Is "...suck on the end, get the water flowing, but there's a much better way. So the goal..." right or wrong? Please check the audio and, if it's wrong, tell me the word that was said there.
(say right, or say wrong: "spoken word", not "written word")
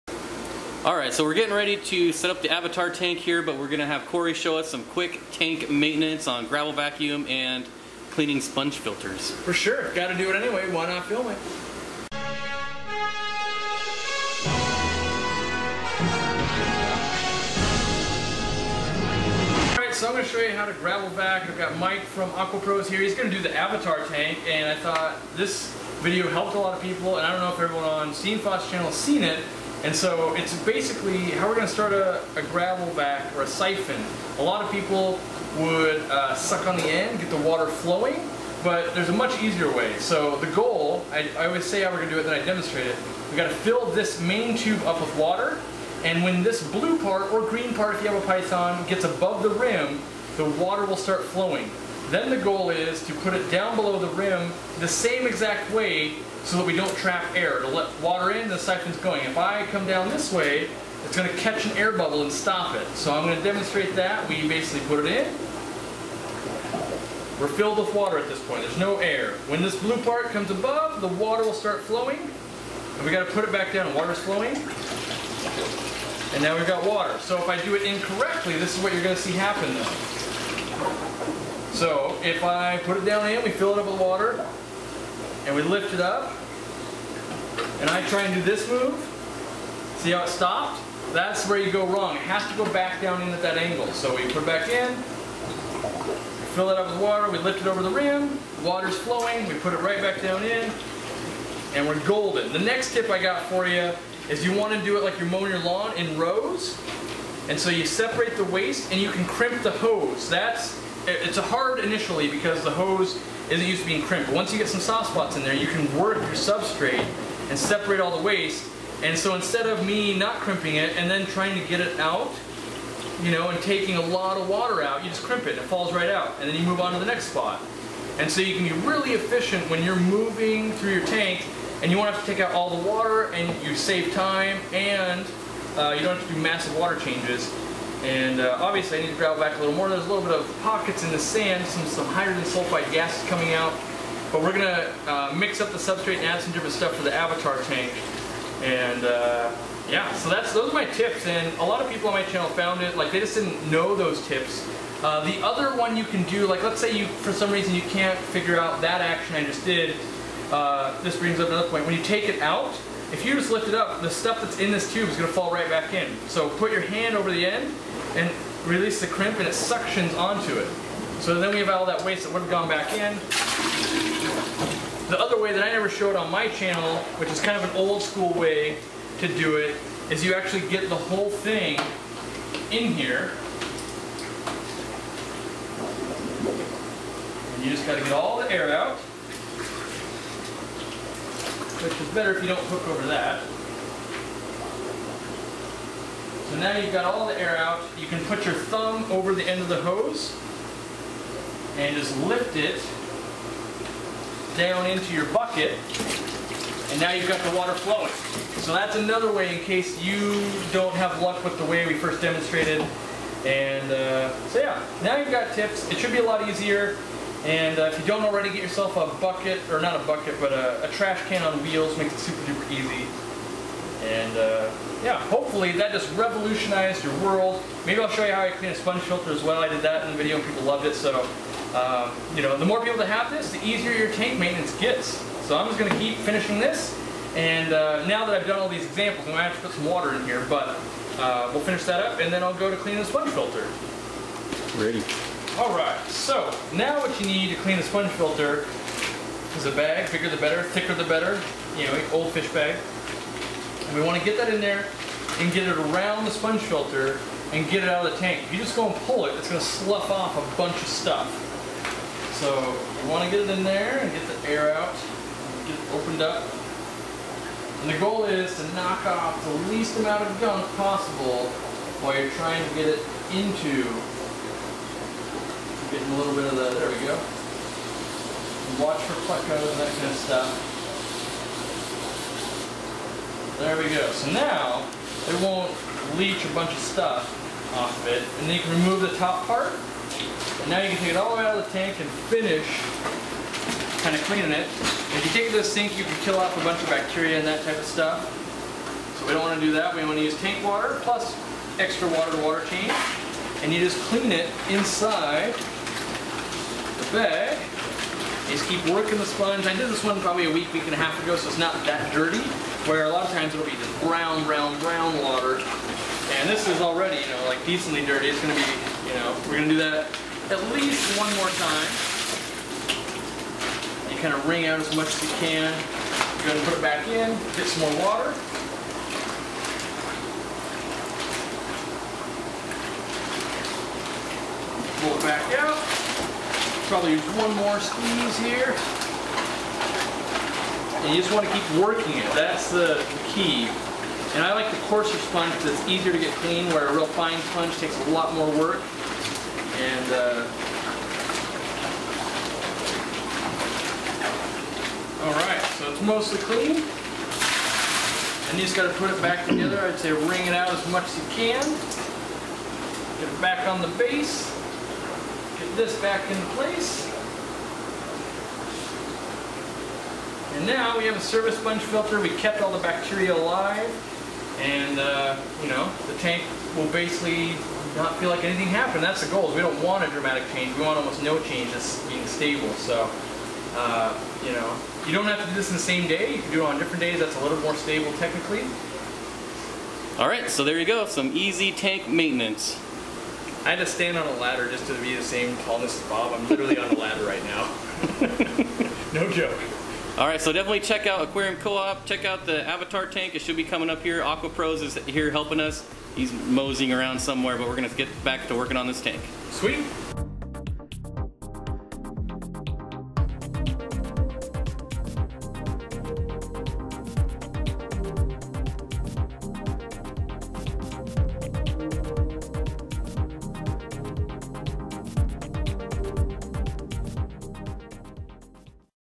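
wrong: "easier", not "better".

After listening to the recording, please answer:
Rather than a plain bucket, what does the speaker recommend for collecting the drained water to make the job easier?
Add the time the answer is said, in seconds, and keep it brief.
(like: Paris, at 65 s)
trash can on wheels, at 220 s.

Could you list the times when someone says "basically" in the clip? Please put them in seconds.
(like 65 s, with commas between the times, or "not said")
30 s, 64 s, 376 s.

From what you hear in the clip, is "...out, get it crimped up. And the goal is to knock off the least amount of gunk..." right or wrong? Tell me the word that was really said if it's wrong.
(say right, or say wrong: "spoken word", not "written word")
wrong: "opened", not "crimped".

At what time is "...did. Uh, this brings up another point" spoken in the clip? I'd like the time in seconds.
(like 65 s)
159 s.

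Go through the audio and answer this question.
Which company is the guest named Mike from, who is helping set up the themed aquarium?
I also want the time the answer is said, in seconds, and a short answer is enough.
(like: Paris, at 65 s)
AquaPros, at 22 s.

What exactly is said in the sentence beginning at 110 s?
That's it's hard initially because the hose isn't used to being crimped.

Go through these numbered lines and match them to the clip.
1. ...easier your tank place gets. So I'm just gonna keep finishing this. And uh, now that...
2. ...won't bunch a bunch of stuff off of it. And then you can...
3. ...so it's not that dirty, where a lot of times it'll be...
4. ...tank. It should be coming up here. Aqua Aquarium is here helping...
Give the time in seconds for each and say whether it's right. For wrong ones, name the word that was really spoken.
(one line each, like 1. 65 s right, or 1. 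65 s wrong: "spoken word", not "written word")
1. 233 s wrong: "maintenance", not "place"
2. 285 s wrong: "leach", not "bunch"
3. 311 s right
4. 403 s wrong: "Pros", not "Aquarium".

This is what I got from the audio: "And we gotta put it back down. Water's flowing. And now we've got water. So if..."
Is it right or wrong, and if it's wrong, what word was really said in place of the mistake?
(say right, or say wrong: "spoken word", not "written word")
right.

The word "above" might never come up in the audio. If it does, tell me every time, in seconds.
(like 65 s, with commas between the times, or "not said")
49 s, 70 s.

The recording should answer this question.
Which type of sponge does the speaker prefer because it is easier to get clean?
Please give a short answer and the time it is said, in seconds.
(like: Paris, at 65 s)
coarser sponge, at 344 s.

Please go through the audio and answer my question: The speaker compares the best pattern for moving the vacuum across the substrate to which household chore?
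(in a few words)
mowing your lawn.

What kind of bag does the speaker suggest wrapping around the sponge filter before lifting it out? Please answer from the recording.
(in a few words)
old fish bag.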